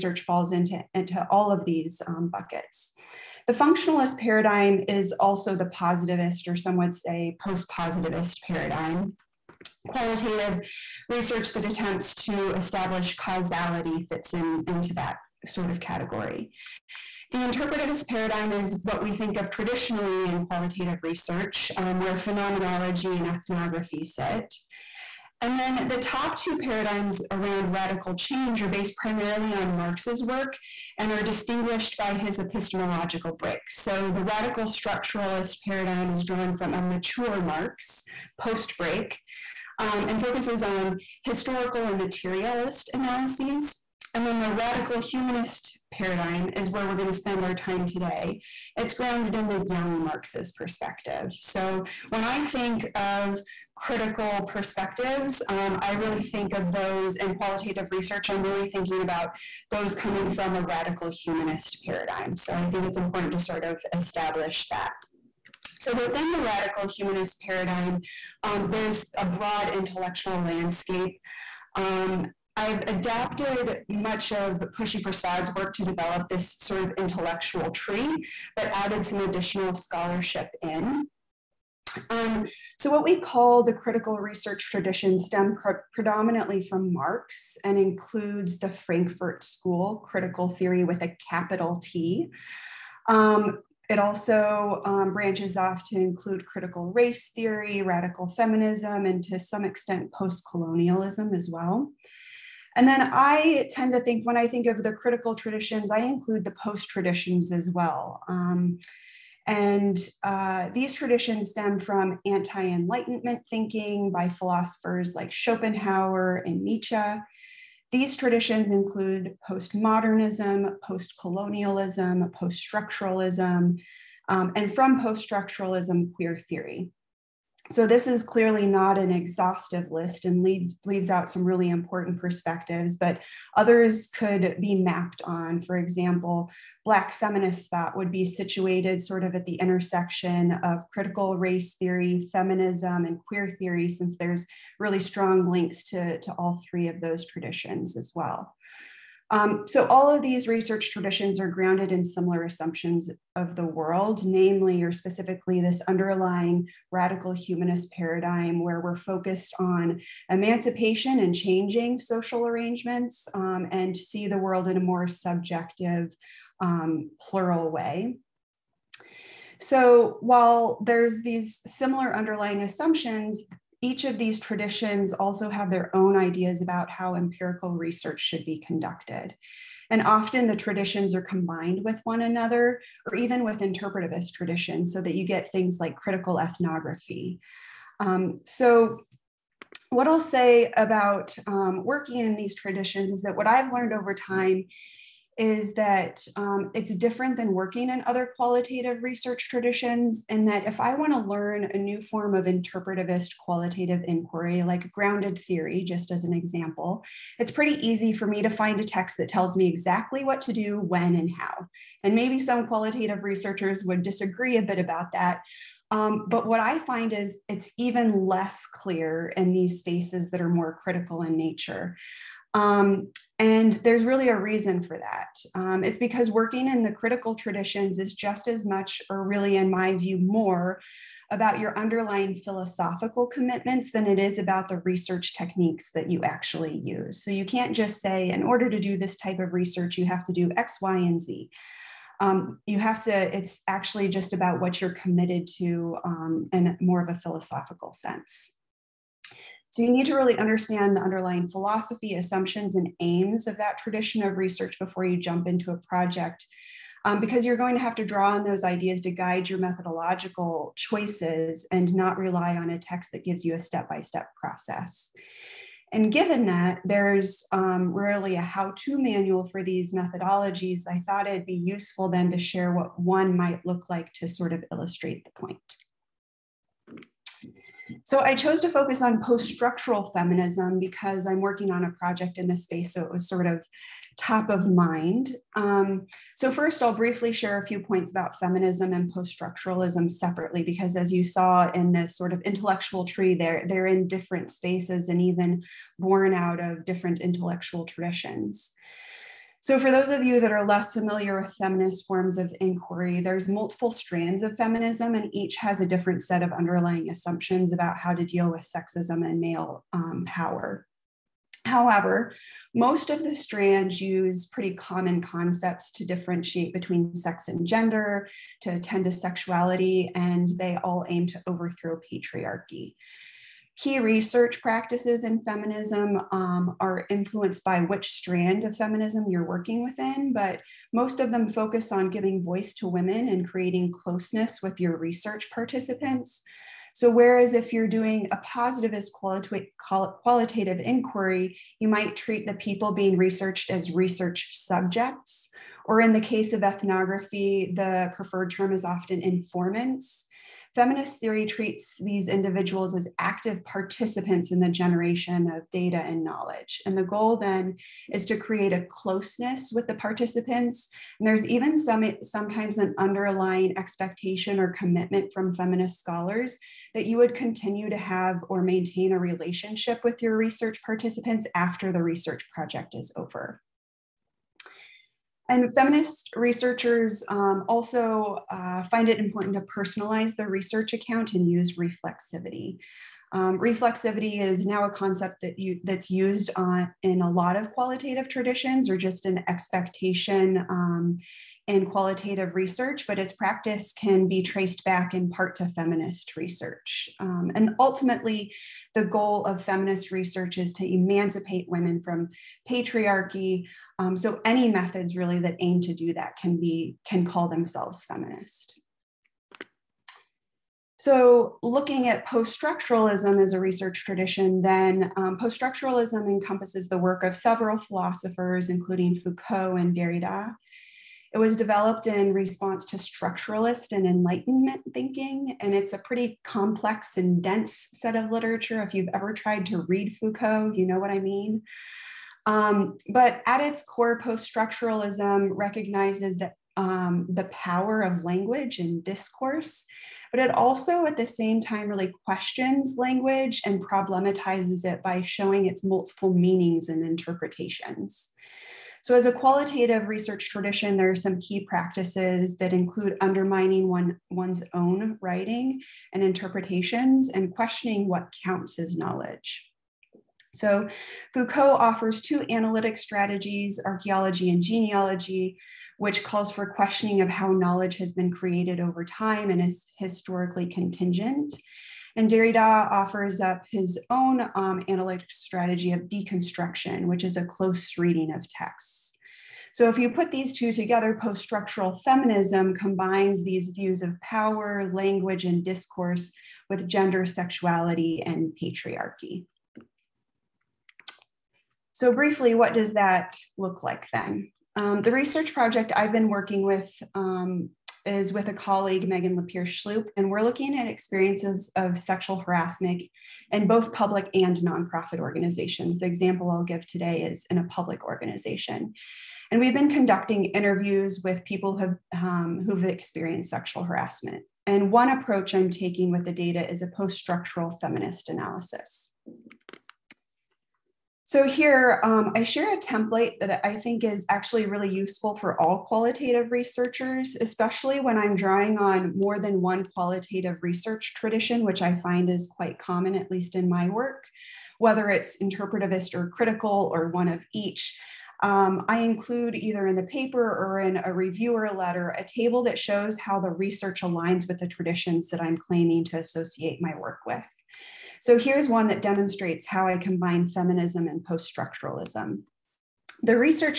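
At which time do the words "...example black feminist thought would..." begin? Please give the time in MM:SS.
02:15.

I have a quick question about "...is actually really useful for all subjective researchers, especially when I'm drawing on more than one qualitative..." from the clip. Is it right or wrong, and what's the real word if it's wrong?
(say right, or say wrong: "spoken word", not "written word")
wrong: "qualitative", not "subjective".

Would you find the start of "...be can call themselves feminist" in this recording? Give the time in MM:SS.
06:46.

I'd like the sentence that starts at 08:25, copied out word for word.
The example I'll give today is in a public organization.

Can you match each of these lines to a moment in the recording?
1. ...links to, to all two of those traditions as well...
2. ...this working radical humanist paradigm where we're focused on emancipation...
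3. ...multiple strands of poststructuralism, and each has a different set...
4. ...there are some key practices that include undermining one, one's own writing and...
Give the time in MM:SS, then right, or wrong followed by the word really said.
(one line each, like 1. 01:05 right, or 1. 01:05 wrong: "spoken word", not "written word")
1. 02:25 wrong: "three", not "two"
2. 02:35 wrong: "underlying", not "working"
3. 05:03 wrong: "feminism", not "poststructuralism"
4. 07:30 right.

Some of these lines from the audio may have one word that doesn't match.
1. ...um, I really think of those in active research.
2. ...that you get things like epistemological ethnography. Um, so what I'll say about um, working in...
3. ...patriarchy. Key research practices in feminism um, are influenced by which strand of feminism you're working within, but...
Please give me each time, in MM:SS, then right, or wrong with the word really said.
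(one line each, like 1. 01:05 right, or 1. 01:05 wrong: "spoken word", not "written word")
1. 00:55 wrong: "qualitative", not "active"
2. 03:05 wrong: "critical", not "epistemological"
3. 05:22 right.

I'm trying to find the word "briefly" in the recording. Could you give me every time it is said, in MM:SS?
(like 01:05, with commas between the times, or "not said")
04:46, 08:12.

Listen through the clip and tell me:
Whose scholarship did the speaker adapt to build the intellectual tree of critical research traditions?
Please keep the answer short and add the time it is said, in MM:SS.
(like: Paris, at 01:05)
Pushkala Prasad, at 01:14.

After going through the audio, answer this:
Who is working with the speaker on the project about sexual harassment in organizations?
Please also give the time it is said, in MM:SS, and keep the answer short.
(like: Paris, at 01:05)
Megan LePere-Schloop, at 08:19.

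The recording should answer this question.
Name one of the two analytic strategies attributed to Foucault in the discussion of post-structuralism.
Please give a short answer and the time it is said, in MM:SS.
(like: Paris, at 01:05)
Archaeology, at 07:43.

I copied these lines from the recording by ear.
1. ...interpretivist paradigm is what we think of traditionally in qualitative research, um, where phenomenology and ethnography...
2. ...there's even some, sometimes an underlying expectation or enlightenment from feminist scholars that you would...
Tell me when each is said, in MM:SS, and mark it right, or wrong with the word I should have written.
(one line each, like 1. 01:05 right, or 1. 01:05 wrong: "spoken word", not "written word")
1. 00:17 right
2. 06:01 wrong: "commitment", not "enlightenment".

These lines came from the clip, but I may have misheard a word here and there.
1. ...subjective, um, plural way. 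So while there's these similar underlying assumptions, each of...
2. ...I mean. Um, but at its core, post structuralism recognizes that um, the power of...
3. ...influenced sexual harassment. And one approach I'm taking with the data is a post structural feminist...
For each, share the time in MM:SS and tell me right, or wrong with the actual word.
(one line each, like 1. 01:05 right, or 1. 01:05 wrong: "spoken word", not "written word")
1. 02:45 right
2. 07:11 right
3. 08:32 wrong: "experienced", not "influenced".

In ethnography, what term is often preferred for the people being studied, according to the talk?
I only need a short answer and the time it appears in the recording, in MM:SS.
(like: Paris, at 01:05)
Informants, at 05:49.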